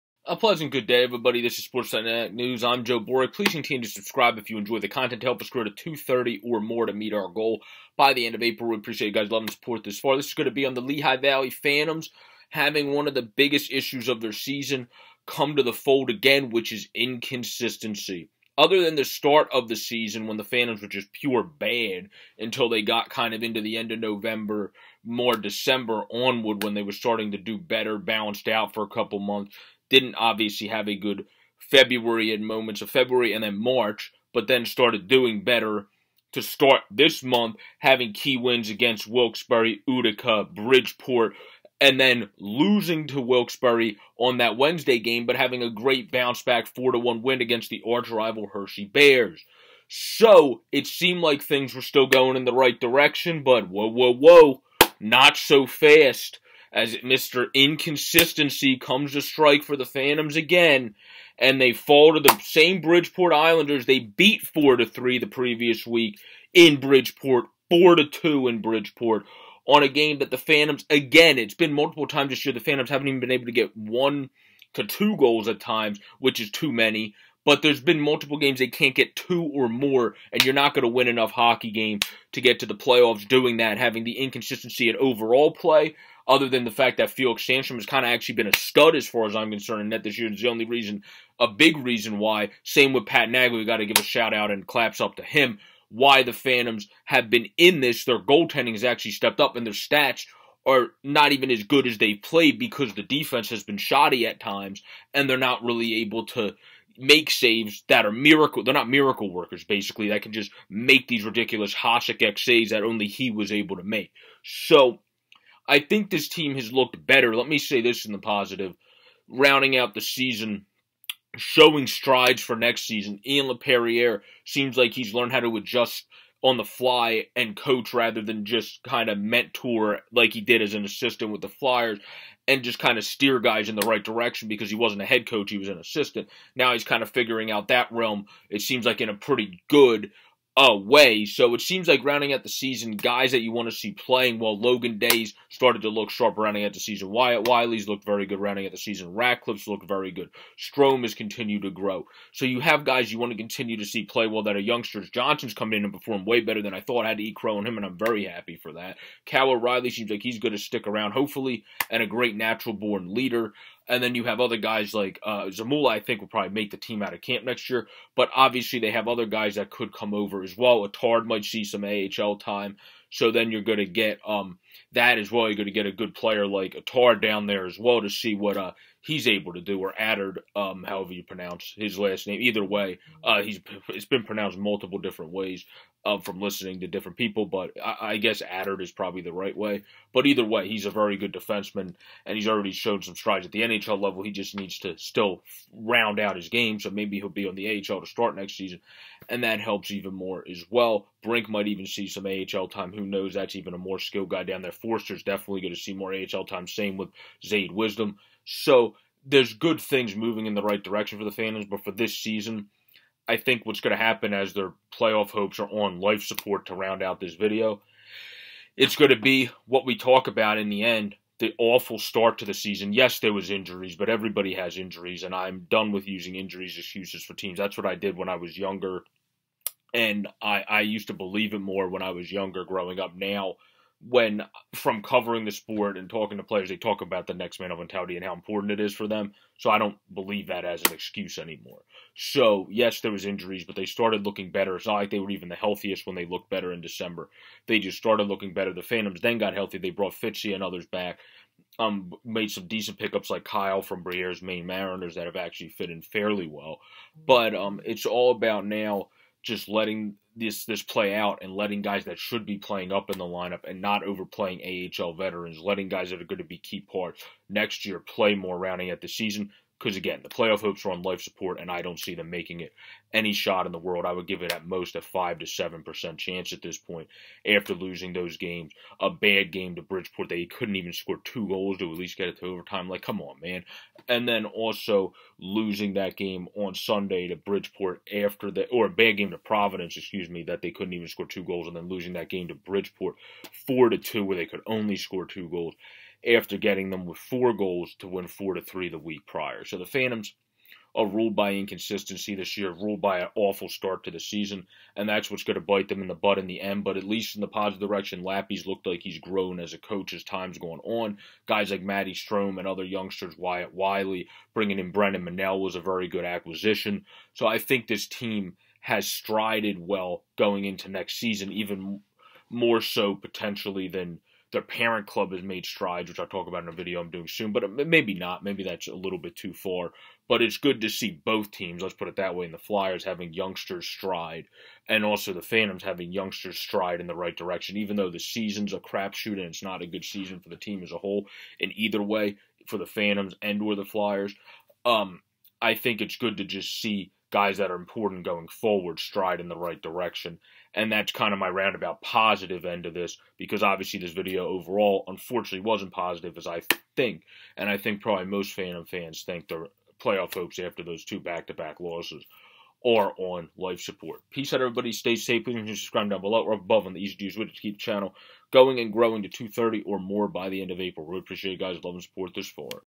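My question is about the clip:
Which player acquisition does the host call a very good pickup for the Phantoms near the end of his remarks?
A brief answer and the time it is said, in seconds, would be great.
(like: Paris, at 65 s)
Brendan Minnell, at 314 s.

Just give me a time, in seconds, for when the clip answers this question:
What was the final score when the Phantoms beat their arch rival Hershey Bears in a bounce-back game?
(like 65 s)
46 s.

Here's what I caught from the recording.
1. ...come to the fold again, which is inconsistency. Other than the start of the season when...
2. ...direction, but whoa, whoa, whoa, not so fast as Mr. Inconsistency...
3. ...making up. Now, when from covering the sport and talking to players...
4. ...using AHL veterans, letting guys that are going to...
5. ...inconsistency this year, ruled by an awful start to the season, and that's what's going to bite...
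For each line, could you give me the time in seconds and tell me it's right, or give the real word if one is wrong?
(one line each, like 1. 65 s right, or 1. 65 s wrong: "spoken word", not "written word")
1. 15 s right
2. 52 s right
3. 232 s wrong: "growing", not "making"
4. 264 s wrong: "overplaying", not "using"
5. 301 s right.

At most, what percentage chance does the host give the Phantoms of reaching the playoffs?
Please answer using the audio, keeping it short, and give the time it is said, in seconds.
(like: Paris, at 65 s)
5 to 7 percent, at 275 s.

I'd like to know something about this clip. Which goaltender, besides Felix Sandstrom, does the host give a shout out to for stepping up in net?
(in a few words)
Pat Nagle.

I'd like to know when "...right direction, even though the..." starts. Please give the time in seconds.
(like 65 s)
337 s.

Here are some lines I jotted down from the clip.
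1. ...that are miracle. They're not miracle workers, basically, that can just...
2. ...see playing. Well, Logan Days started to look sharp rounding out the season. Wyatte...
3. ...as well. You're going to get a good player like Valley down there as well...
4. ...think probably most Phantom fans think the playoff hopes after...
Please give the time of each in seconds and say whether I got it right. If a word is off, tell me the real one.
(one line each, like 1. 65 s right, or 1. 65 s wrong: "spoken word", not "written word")
1. 107 s right
2. 143 s right
3. 175 s wrong: "Atar", not "Valley"
4. 357 s right.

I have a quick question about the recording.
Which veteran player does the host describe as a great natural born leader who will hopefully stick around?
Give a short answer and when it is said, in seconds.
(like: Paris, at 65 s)
Cal O'Reilly, at 159 s.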